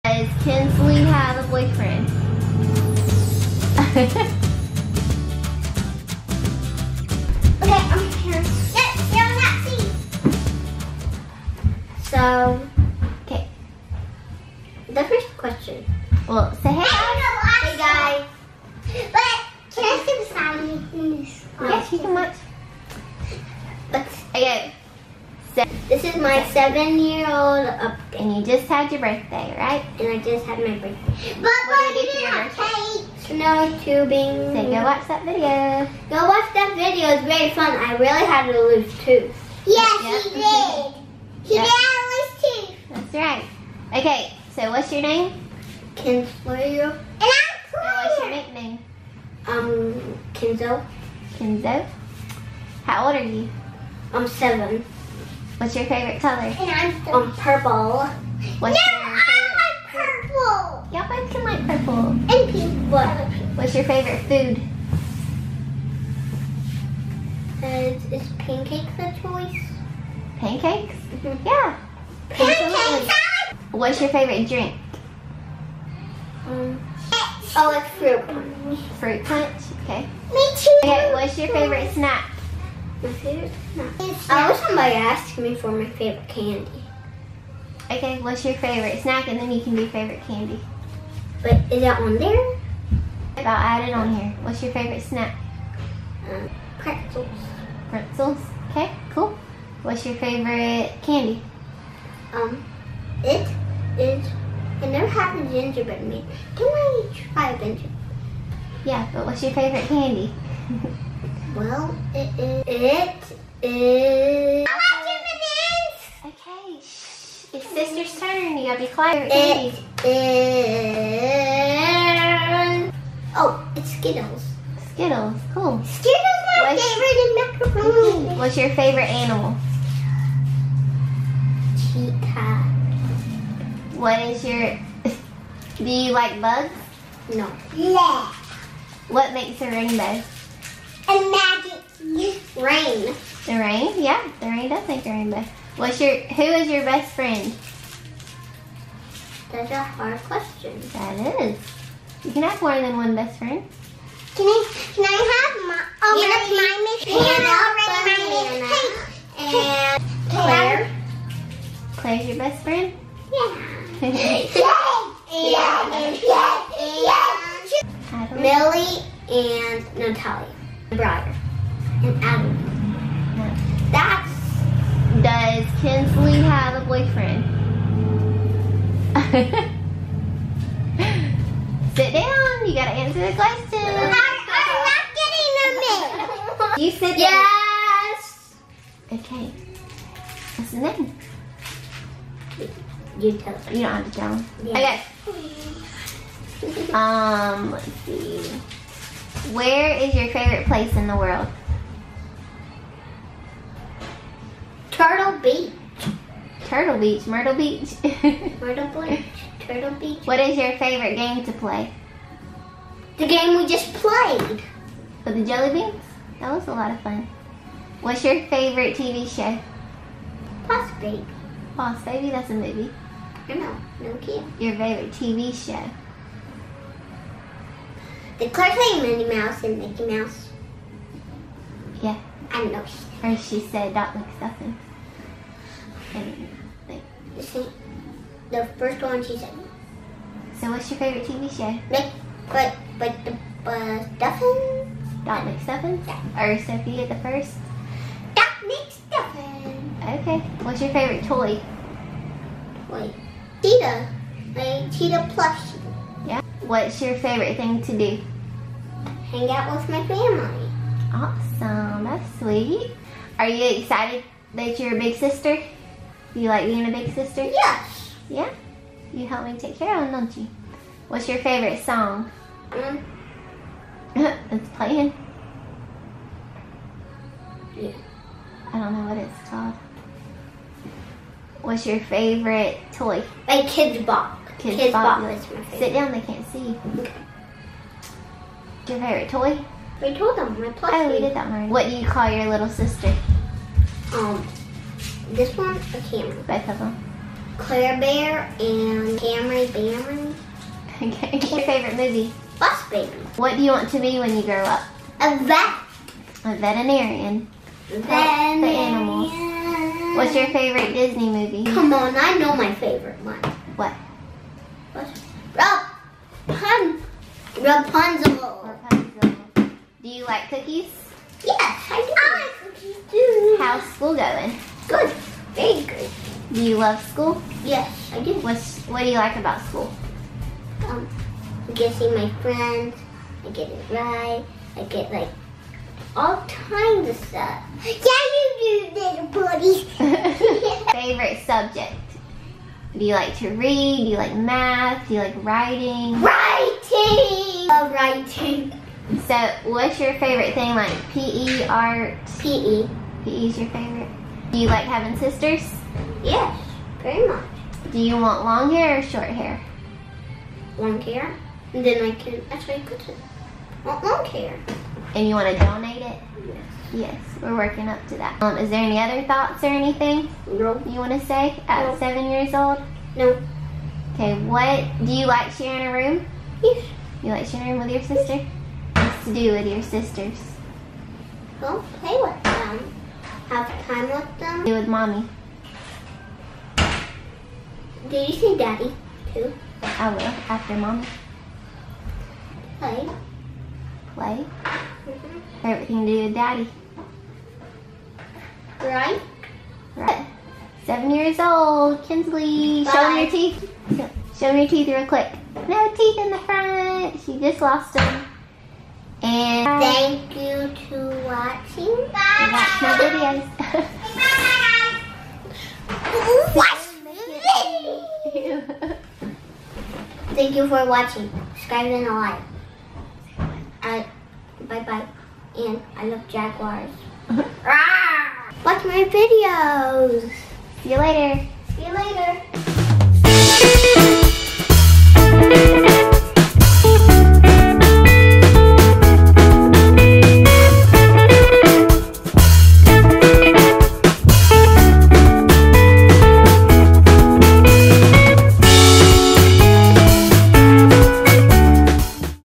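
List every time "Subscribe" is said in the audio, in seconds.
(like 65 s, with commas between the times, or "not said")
421 s.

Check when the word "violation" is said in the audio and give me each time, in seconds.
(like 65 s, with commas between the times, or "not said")
not said.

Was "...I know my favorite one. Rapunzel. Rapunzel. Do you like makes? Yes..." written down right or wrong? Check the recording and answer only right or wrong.
wrong.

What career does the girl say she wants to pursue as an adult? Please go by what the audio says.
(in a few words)
Veterinarian.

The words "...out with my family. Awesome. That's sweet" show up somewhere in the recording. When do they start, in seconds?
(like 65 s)
259 s.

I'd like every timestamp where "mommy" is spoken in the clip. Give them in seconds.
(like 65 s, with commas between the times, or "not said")
384 s, 390 s.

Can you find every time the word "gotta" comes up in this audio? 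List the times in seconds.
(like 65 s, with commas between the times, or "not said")
118 s, 182 s.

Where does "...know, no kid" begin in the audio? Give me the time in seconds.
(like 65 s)
223 s.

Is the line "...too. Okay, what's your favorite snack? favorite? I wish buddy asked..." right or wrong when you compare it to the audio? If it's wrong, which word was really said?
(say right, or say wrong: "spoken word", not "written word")
wrong: "somebody", not "buddy".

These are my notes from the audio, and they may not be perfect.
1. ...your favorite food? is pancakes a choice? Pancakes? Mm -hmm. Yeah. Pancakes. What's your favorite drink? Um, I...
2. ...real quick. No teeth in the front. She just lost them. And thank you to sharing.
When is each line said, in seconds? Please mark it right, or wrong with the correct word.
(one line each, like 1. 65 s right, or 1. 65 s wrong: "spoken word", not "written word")
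1. 63 s right
2. 404 s wrong: "watching", not "sharing".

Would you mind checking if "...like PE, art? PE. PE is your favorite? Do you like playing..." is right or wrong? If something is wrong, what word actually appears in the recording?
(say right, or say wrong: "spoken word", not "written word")
wrong: "having", not "playing".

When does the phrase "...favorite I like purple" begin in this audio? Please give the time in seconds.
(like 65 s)
59 s.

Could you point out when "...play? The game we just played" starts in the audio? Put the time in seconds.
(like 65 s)
211 s.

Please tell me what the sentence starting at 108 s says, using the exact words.
Yeah, but what's your favorite candy?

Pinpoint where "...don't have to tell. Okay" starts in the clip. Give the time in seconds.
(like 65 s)
193 s.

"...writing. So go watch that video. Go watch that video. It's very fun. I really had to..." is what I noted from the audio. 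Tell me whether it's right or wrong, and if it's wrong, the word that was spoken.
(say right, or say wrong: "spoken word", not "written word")
wrong: "tubing", not "writing".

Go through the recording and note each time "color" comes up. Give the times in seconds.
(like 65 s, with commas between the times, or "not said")
56 s.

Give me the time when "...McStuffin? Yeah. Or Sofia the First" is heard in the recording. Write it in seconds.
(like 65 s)
245 s.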